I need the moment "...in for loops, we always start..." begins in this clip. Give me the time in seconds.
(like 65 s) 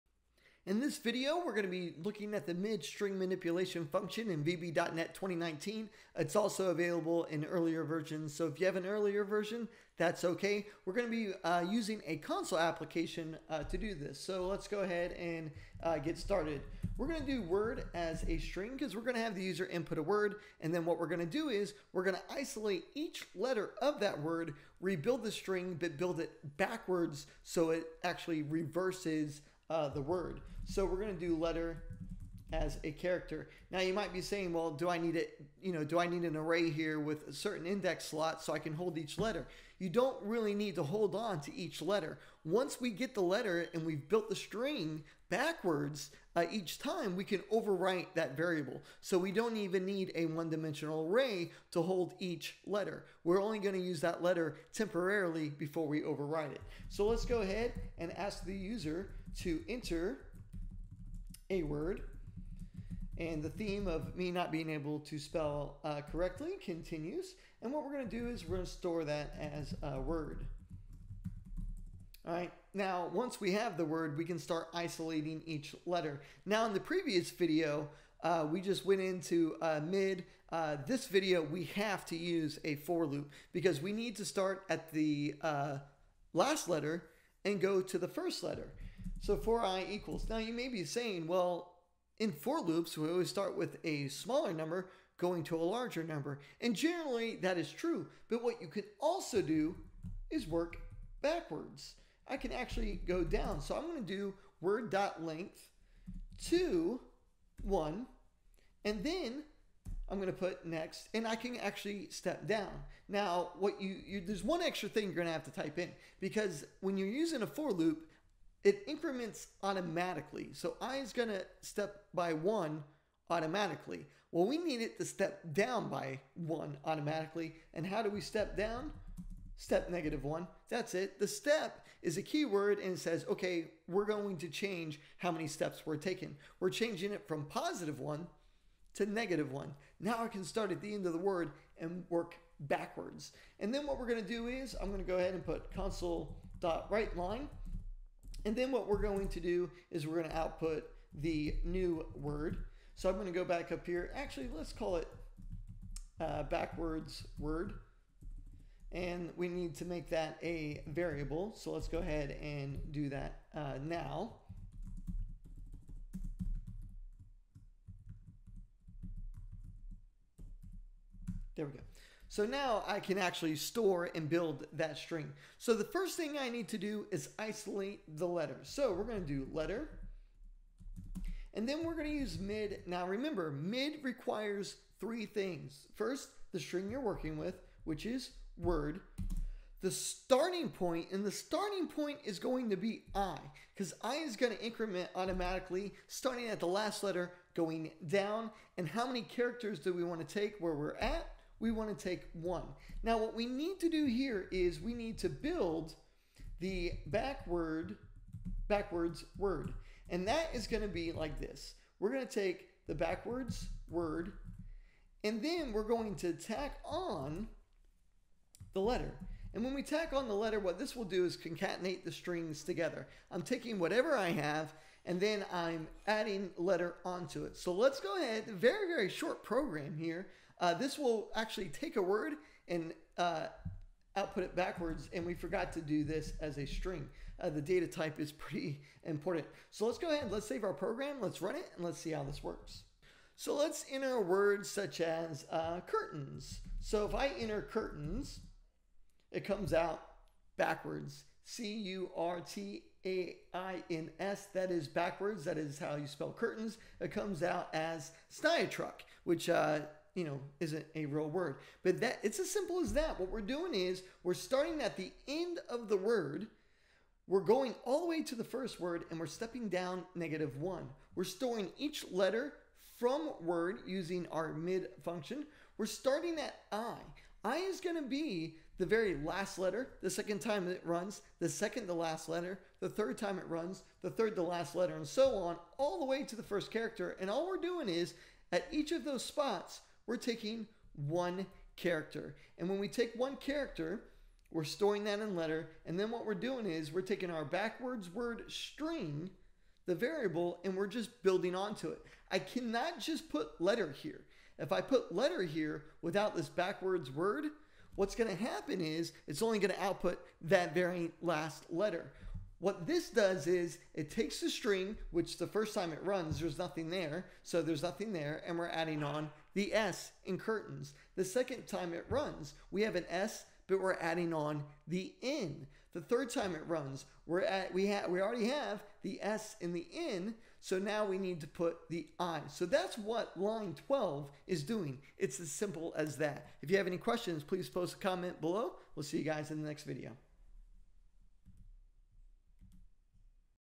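92 s.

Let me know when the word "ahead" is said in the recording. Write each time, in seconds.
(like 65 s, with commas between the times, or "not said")
14 s, 57 s, 145 s, 161 s, 228 s, 240 s.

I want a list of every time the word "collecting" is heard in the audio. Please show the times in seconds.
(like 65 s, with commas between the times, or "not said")
not said.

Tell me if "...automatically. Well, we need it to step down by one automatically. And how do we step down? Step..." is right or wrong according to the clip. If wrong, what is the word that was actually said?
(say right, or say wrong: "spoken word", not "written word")
right.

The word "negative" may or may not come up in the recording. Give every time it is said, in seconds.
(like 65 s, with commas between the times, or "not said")
129 s, 139 s, 270 s.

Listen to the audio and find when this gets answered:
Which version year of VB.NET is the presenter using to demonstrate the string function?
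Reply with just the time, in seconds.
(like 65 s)
5 s.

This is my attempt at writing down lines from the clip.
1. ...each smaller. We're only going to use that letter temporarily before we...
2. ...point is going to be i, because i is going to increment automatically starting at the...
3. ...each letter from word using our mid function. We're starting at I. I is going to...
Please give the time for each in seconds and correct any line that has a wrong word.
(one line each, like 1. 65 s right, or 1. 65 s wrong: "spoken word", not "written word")
1. 52 s wrong: "letter", not "smaller"
2. 191 s right
3. 271 s right.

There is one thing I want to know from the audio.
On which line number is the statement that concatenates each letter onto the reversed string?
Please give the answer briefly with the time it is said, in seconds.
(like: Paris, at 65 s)
12, at 333 s.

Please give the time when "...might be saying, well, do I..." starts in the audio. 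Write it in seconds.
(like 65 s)
33 s.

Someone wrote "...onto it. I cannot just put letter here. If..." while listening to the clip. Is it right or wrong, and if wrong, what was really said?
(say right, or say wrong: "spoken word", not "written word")
right.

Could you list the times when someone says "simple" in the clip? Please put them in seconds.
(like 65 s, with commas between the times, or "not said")
262 s, 335 s.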